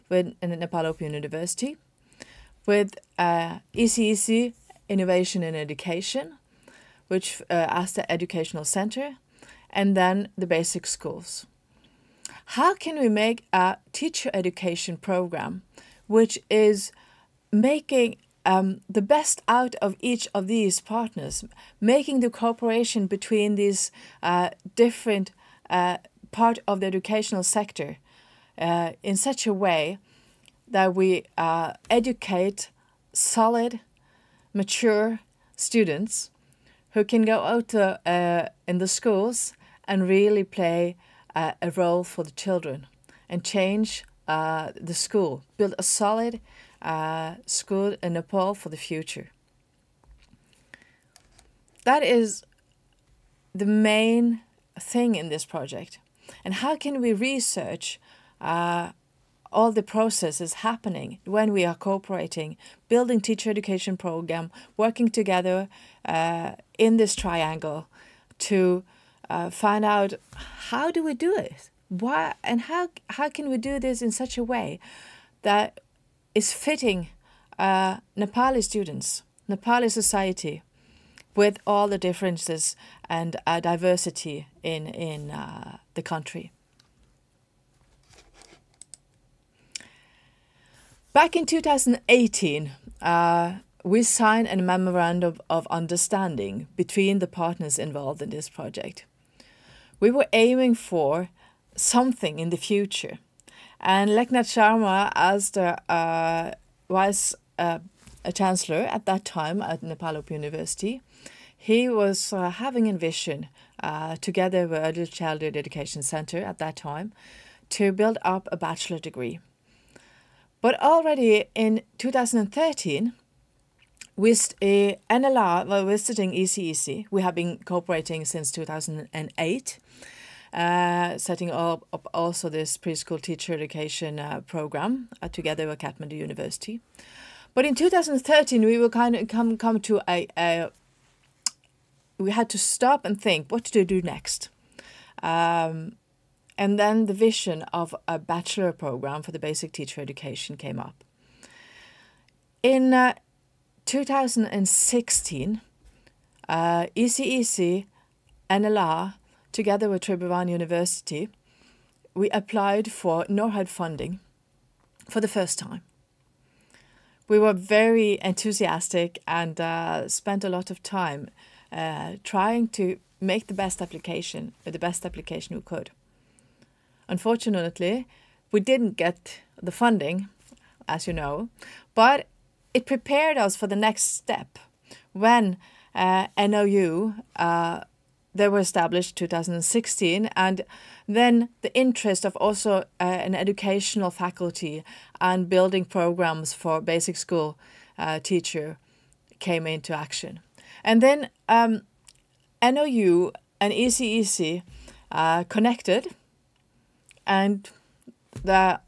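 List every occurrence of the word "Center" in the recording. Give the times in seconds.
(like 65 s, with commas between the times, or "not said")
8 s, 116 s.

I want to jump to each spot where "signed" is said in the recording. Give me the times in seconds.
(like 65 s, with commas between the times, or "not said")
94 s.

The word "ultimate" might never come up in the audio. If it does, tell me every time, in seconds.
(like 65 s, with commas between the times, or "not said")
not said.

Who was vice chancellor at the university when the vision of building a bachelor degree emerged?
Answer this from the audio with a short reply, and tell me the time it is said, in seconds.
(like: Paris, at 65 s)
Lekhnat Sharma, at 104 s.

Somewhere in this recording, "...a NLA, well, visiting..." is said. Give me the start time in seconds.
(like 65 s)
124 s.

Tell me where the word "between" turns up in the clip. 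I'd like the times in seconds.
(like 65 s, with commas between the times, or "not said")
23 s, 96 s.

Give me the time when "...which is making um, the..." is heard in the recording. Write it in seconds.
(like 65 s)
16 s.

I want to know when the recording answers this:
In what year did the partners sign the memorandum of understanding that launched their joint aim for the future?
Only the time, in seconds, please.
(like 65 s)
91 s.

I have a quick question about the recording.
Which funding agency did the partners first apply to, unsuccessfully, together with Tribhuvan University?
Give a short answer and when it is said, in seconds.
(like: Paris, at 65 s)
NORAD, at 163 s.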